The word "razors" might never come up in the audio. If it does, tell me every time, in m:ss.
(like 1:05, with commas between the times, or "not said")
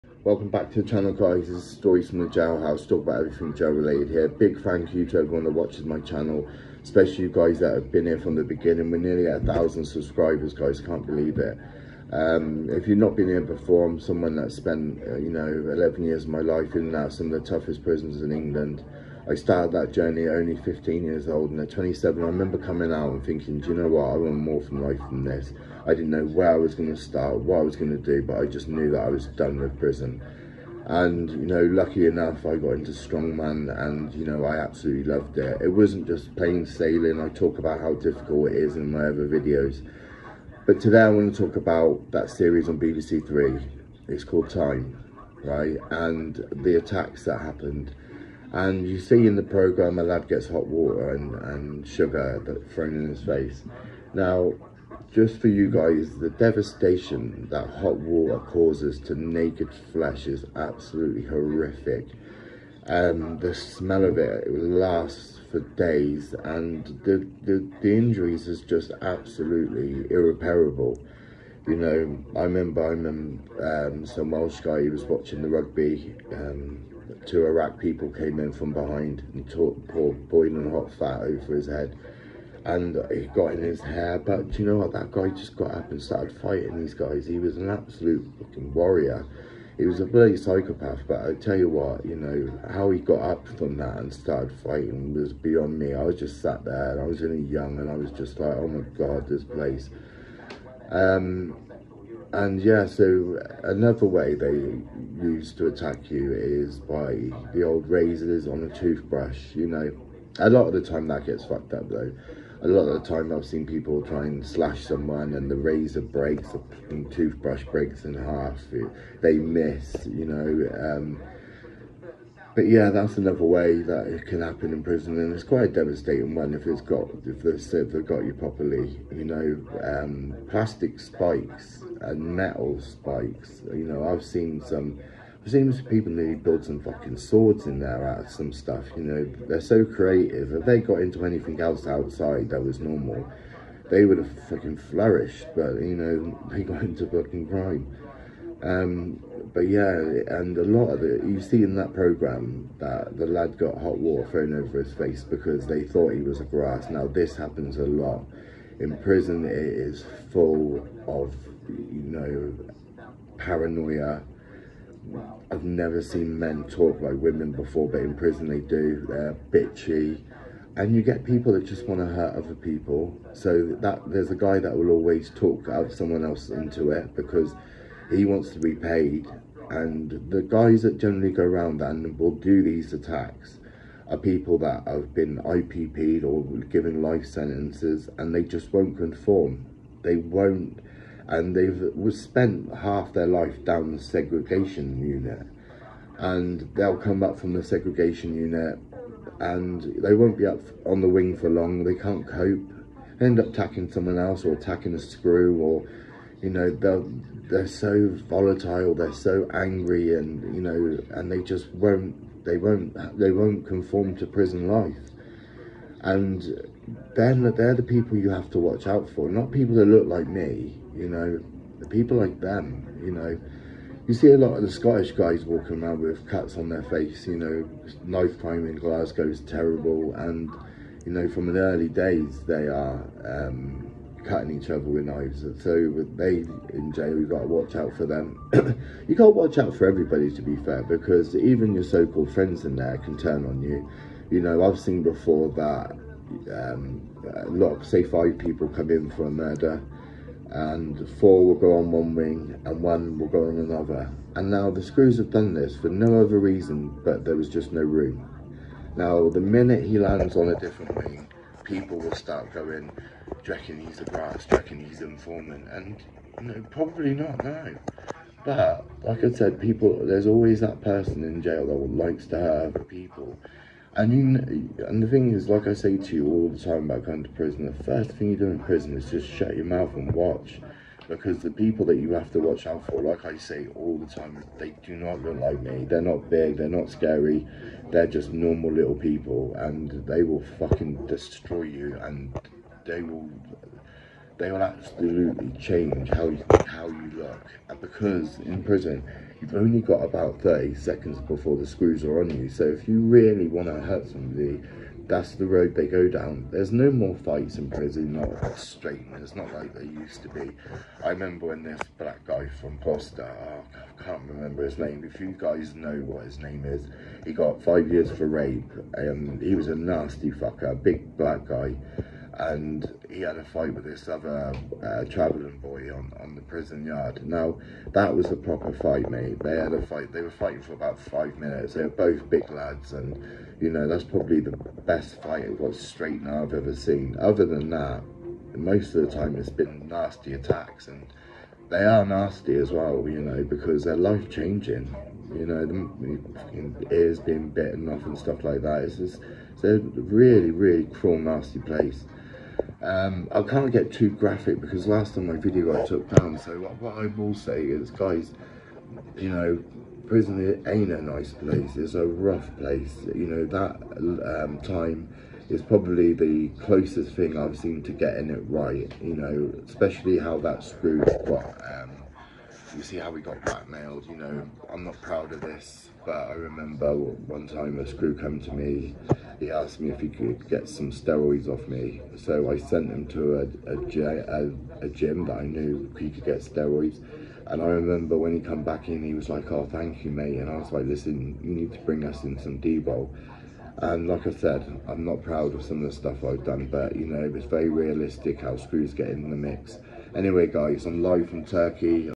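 1:47, 1:55.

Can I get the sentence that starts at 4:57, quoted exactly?
And because in prison, you've only got about 30 seconds before the screws are on you.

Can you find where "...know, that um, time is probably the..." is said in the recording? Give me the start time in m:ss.
6:03.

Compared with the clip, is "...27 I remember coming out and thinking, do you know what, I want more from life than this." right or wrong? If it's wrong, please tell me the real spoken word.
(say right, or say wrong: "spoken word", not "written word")
right.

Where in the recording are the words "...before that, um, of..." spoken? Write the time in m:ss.
4:05.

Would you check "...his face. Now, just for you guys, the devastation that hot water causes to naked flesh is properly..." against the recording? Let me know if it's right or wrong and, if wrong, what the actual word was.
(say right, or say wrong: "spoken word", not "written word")
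wrong: "absolutely", not "properly".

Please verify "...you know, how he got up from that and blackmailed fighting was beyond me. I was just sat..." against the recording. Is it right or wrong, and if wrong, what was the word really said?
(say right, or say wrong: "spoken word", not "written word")
wrong: "started", not "blackmailed".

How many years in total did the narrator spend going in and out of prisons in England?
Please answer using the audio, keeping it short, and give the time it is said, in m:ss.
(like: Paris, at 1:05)
11, at 0:15.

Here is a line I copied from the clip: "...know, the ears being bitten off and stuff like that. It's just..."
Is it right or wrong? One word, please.
right.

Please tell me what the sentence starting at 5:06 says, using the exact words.
There's no more fights in prison, not straighteners, not like they used to be.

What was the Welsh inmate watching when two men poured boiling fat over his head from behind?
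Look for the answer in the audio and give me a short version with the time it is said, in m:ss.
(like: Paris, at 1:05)
The rugby, at 1:15.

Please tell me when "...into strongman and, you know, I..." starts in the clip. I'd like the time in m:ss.
0:32.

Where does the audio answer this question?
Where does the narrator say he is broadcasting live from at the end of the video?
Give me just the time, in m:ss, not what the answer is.
6:41.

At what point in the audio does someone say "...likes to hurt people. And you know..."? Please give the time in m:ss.
4:31.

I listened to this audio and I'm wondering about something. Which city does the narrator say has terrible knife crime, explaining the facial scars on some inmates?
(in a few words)
Glasgow.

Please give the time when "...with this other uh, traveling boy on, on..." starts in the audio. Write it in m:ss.
5:23.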